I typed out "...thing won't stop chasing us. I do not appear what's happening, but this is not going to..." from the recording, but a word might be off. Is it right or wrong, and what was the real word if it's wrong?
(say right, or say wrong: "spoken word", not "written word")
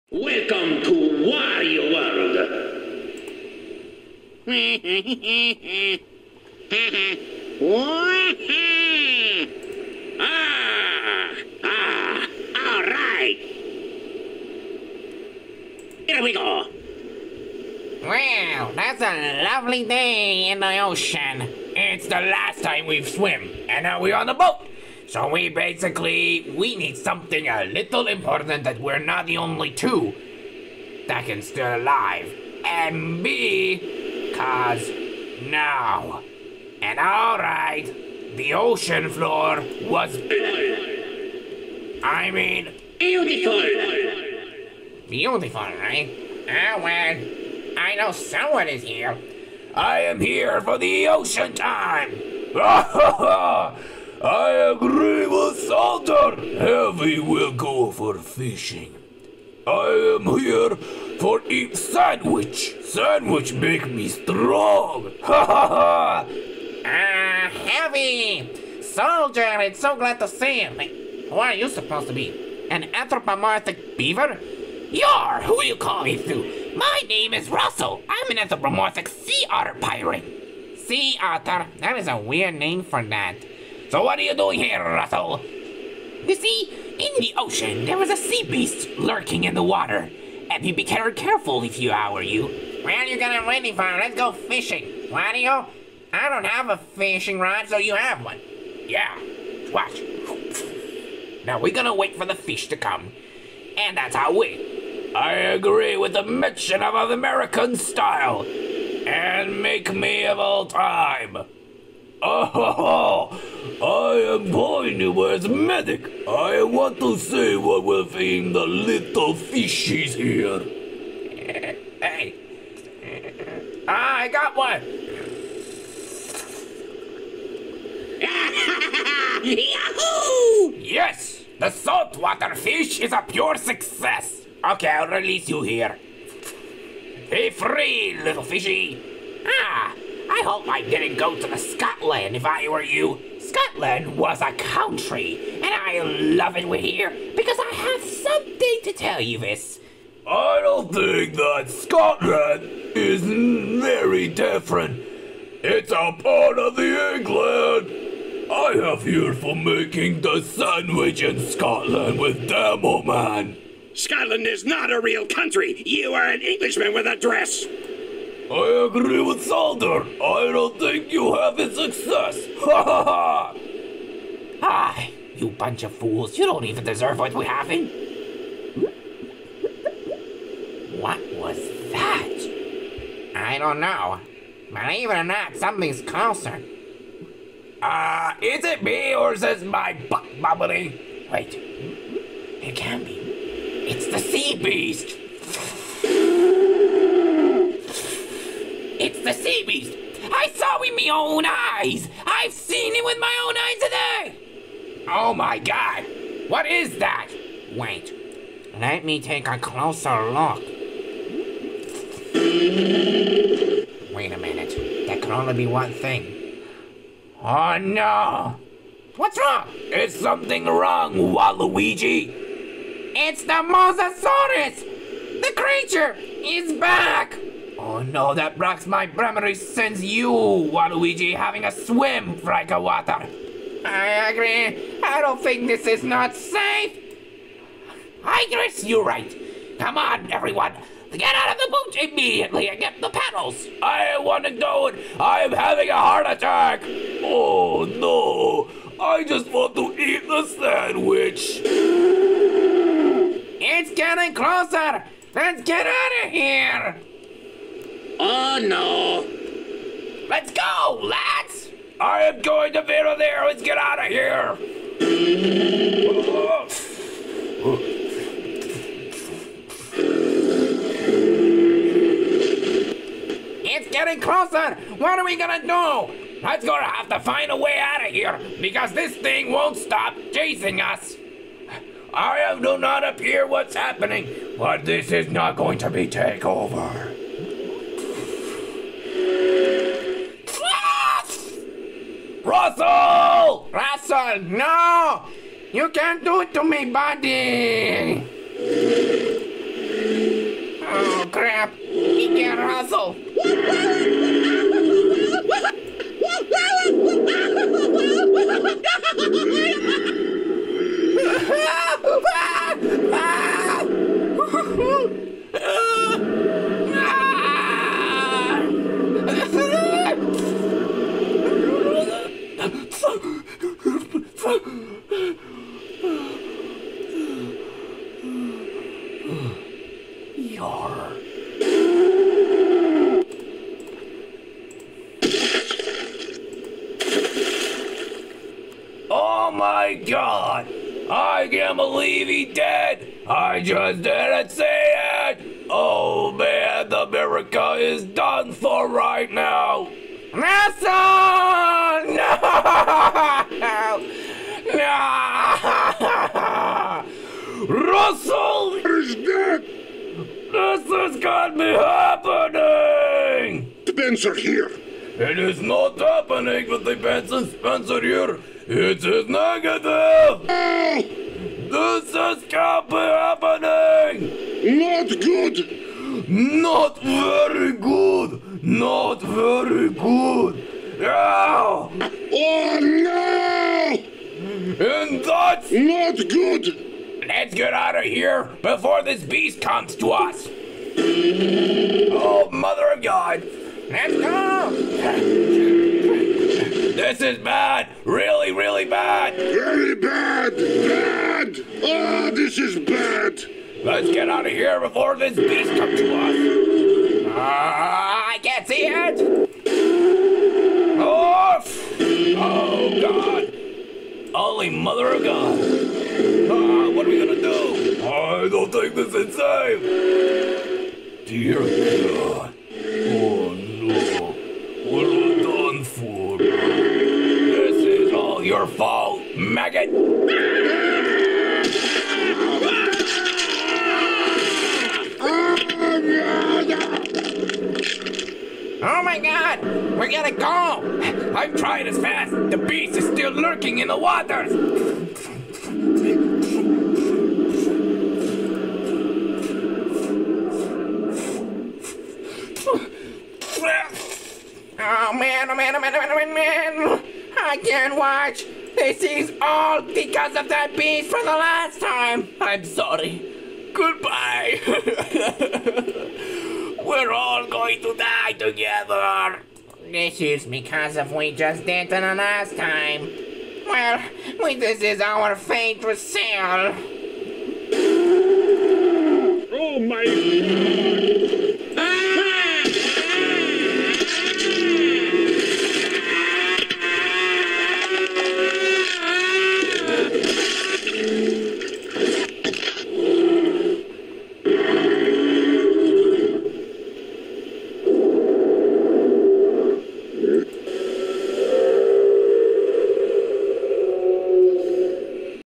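right.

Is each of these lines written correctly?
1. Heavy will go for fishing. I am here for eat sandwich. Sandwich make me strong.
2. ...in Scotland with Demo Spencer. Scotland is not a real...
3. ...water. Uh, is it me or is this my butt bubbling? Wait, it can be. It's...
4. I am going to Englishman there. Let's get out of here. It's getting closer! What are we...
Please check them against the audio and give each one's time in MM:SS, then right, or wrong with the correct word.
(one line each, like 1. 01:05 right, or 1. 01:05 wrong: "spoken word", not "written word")
1. 00:56 right
2. 02:41 wrong: "Man", not "Spencer"
3. 03:06 wrong: "closer", not "water"
4. 04:21 wrong: "Vera", not "Englishman".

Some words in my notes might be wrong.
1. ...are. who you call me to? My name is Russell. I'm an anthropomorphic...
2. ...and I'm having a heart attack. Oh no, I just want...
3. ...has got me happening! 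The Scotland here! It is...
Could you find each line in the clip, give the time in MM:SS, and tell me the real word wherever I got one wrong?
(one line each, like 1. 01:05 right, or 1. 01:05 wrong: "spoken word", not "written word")
1. 01:15 right
2. 04:04 right
3. 06:00 wrong: "Benzer", not "Scotland".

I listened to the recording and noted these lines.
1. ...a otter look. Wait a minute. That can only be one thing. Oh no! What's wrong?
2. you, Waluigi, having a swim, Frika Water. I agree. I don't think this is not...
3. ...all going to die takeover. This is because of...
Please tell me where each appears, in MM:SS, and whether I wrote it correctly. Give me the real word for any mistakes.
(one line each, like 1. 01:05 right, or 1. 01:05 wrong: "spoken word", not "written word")
1. 03:29 wrong: "closer", not "otter"
2. 03:50 right
3. 07:47 wrong: "together", not "takeover".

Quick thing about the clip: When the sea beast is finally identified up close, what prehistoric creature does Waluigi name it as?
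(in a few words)
Mosasaurus.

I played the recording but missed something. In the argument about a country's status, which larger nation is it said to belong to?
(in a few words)
England.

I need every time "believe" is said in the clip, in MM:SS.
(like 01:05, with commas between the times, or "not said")
03:04, 05:41.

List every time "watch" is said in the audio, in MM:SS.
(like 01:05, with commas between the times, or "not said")
01:39, 07:37.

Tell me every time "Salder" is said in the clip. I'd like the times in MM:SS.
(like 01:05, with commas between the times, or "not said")
02:49.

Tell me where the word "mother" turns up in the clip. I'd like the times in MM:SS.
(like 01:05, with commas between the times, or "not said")
06:32, 06:54.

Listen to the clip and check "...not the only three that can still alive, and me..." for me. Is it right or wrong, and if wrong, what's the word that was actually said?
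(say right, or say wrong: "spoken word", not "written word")
wrong: "two", not "three".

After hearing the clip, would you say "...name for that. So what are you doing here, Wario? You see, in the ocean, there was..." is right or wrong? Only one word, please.
wrong.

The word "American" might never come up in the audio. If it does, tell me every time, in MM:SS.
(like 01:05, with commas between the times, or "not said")
01:47.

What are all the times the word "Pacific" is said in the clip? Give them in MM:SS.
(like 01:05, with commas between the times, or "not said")
not said.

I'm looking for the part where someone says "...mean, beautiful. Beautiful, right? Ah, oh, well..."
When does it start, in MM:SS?
00:42.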